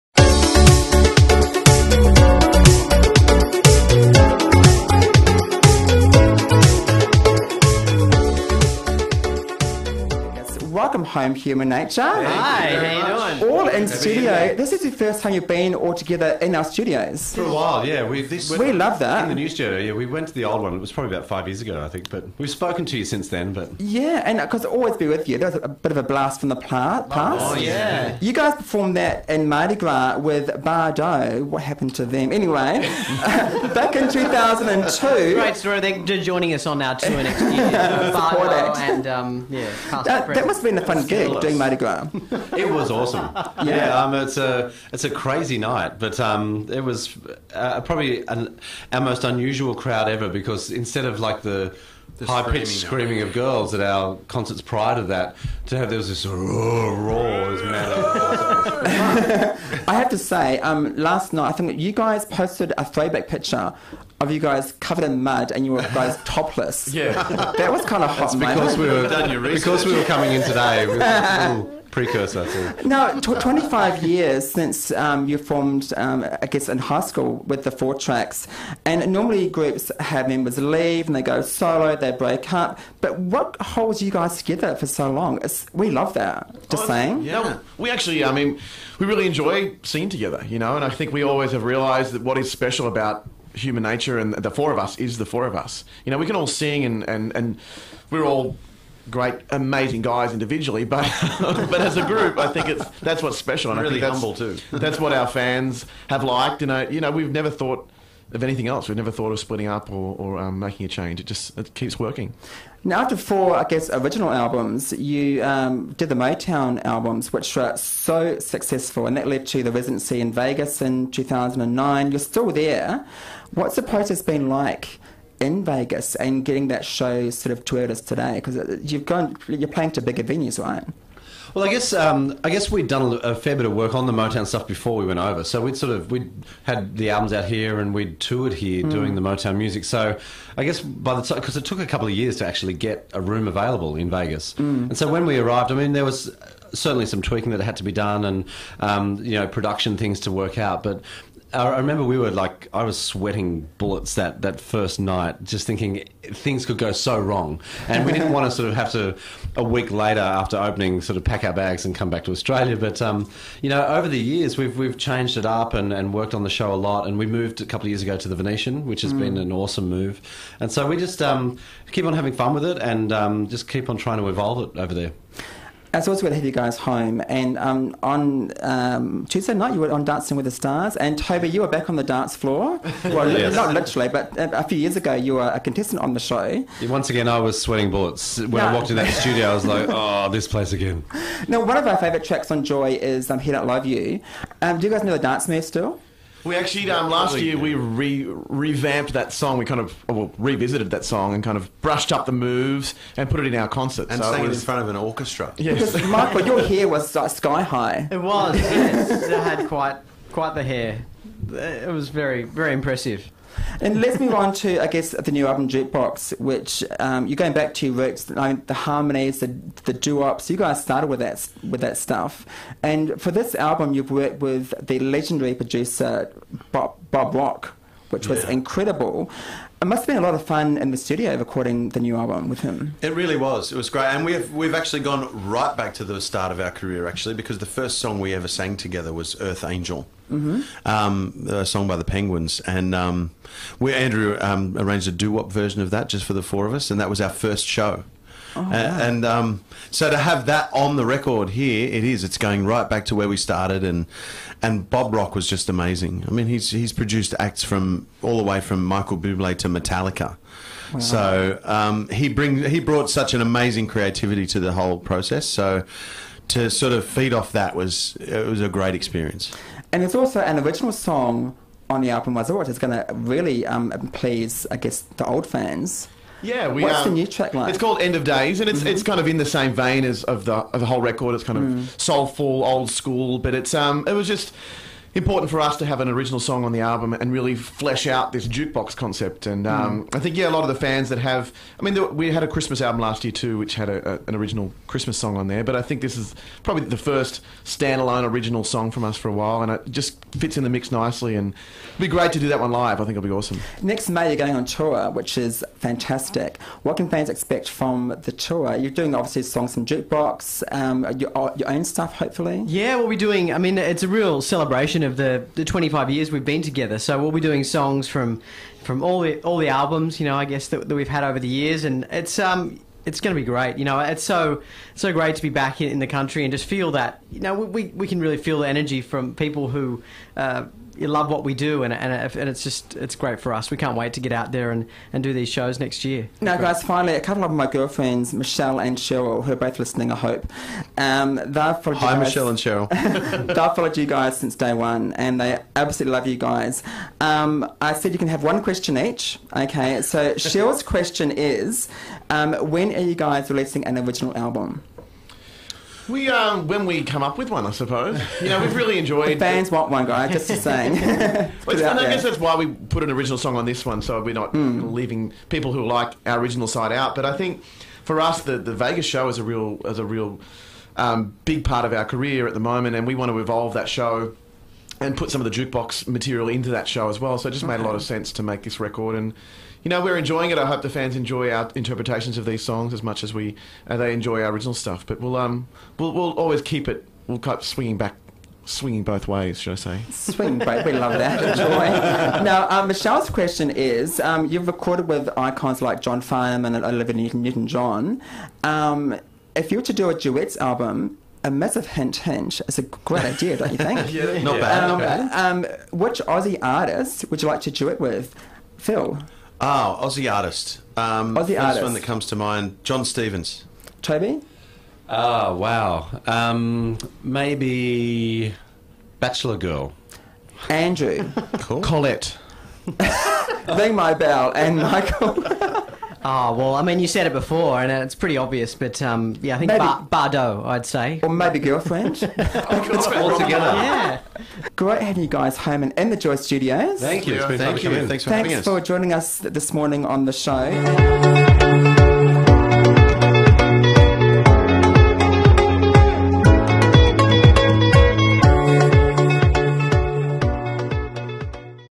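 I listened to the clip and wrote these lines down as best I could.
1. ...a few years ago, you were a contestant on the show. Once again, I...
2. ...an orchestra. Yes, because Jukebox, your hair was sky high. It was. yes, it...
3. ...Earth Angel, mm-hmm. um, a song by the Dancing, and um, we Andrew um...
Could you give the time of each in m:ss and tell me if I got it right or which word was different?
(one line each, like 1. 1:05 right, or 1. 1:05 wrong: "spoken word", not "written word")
1. 3:04 right
2. 3:24 wrong: "Michael", not "Jukebox"
3. 3:59 wrong: "Penguins", not "Dancing".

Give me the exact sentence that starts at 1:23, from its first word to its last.
But what holds you guys together for so long?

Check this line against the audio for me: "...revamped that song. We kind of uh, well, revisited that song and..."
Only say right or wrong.
right.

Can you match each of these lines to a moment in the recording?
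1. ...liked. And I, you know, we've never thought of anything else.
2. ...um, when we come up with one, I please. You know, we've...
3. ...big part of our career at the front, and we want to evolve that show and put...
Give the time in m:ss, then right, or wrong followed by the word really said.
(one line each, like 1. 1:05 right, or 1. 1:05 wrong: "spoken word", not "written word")
1. 1:46 right
2. 5:56 wrong: "suppose", not "please"
3. 6:11 wrong: "moment", not "front".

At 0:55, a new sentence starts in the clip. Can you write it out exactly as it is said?
To have there was this roar, roar mad.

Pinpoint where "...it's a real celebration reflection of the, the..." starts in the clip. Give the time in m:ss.
5:13.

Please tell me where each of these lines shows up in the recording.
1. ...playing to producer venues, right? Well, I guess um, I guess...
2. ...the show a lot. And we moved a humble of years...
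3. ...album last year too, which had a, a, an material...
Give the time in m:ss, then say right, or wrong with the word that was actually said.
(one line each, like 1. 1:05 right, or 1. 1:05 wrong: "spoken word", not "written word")
1. 2:09 wrong: "bigger", not "producer"
2. 2:46 wrong: "couple", not "humble"
3. 4:52 wrong: "original", not "material".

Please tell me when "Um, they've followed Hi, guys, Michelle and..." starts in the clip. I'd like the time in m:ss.
5:40.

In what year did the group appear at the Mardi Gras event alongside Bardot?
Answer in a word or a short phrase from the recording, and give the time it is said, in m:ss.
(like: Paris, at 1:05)
2002, at 0:34.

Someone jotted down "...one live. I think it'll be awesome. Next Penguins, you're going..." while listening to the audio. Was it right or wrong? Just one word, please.
wrong.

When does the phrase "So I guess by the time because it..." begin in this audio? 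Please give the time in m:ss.
2:19.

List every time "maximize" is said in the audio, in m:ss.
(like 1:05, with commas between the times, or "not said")
not said.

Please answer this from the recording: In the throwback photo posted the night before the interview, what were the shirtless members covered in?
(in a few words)
Mud.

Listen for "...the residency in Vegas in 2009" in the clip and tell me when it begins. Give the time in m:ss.
1:59.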